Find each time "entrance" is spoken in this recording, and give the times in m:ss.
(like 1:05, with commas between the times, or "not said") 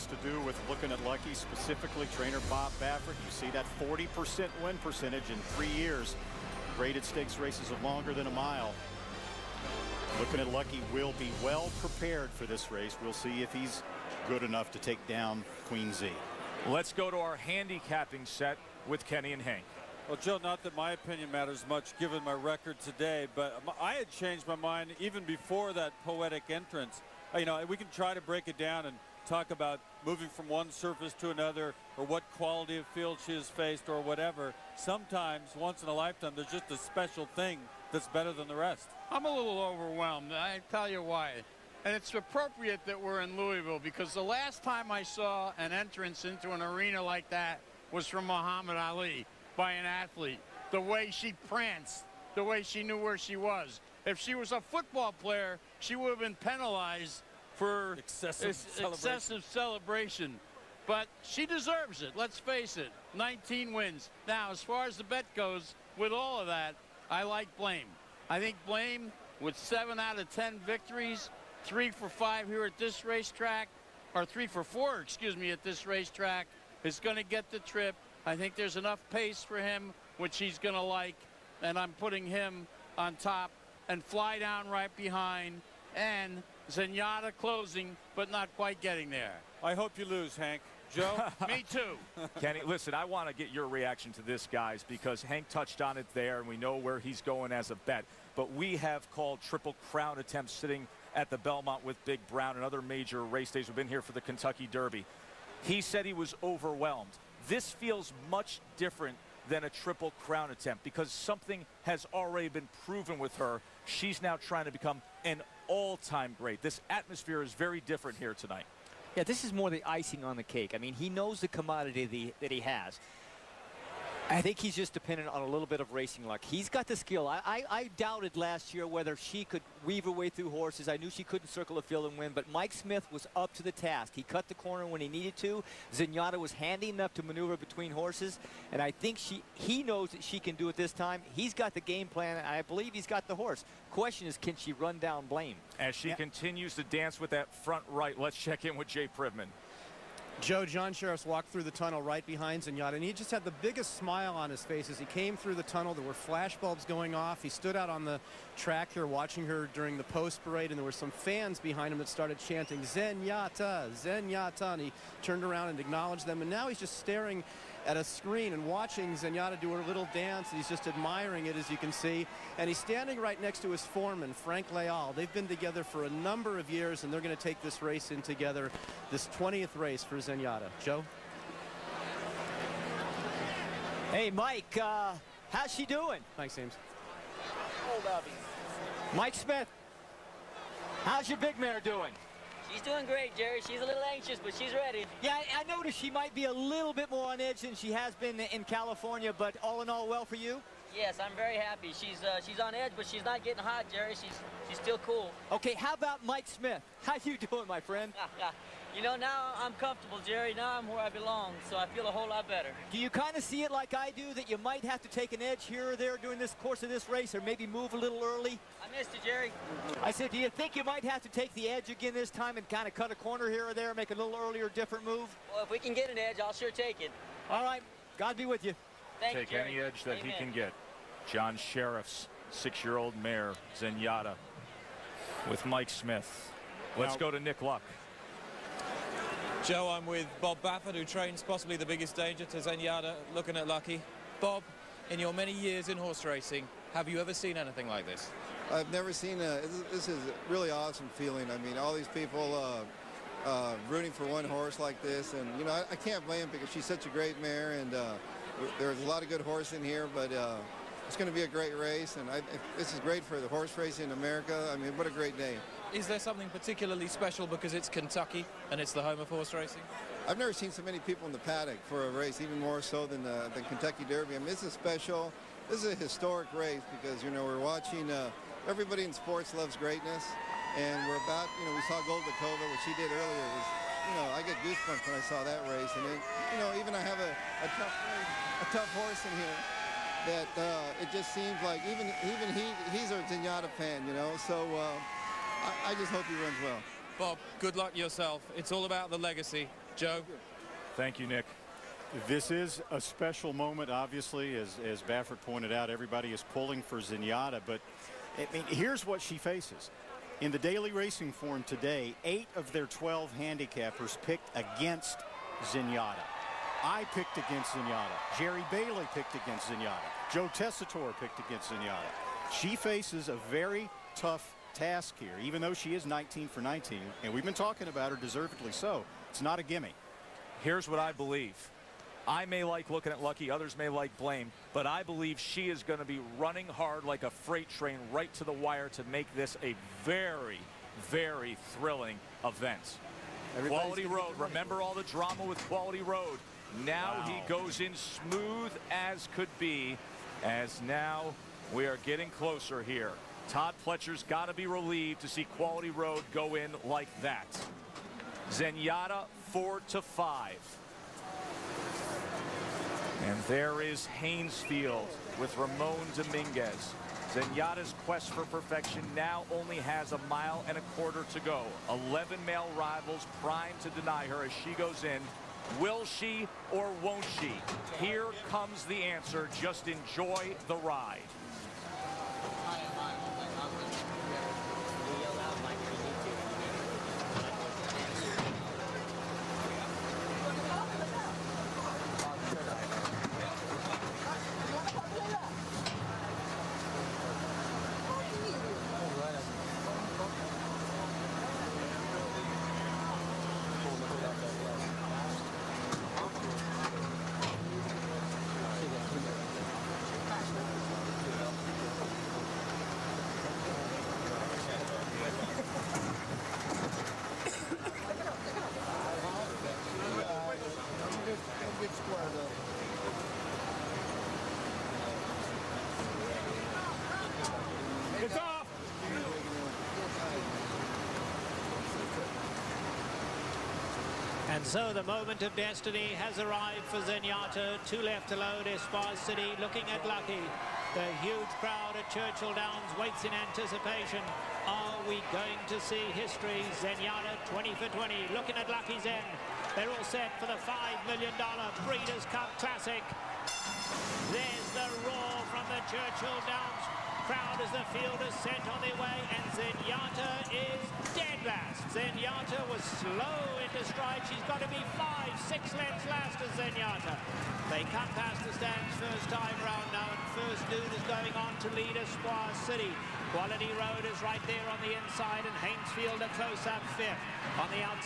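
0:26, 0:45.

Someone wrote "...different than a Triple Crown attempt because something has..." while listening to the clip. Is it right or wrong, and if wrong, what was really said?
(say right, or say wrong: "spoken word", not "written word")
right.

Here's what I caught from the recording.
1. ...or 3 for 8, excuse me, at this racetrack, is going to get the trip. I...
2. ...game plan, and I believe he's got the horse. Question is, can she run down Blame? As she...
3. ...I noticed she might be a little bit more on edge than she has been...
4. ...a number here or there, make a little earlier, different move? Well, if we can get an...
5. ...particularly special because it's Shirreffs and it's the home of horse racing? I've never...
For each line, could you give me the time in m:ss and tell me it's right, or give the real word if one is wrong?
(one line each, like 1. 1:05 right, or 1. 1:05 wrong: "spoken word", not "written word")
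1. 1:14 wrong: "4", not "8"
2. 2:21 right
3. 3:15 right
4. 3:43 wrong: "corner", not "number"
5. 4:26 wrong: "Kentucky", not "Shirreffs".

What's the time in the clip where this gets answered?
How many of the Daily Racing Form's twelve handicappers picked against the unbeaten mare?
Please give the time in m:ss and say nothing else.
5:12.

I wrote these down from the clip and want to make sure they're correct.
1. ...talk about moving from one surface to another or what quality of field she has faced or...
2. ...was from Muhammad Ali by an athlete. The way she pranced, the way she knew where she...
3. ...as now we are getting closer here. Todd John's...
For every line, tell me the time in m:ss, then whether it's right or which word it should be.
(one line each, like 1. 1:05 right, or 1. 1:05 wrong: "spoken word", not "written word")
1. 0:29 right
2. 0:47 right
3. 5:50 wrong: "Pletcher", not "John".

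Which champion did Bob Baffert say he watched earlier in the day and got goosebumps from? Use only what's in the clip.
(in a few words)
Goldikova.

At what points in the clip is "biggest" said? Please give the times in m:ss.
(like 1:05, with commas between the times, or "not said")
2:33, 4:01.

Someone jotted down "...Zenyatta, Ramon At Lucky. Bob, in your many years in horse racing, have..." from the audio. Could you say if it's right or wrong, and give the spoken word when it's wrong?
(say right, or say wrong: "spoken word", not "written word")
wrong: "Lookin", not "Ramon".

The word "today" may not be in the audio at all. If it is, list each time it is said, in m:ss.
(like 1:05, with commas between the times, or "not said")
0:22, 5:11.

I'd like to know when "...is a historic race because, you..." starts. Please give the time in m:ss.
4:35.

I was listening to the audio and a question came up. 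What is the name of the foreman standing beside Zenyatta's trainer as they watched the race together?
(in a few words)
Frank Leal.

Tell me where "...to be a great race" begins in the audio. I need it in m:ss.
4:21.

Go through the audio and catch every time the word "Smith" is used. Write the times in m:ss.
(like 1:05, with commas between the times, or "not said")
2:12, 3:09, 3:26, 3:55.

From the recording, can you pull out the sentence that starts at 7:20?
The huge crowd at Churchill Downs waits in anticipation.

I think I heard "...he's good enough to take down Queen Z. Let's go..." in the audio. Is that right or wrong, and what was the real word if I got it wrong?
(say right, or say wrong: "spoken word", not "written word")
right.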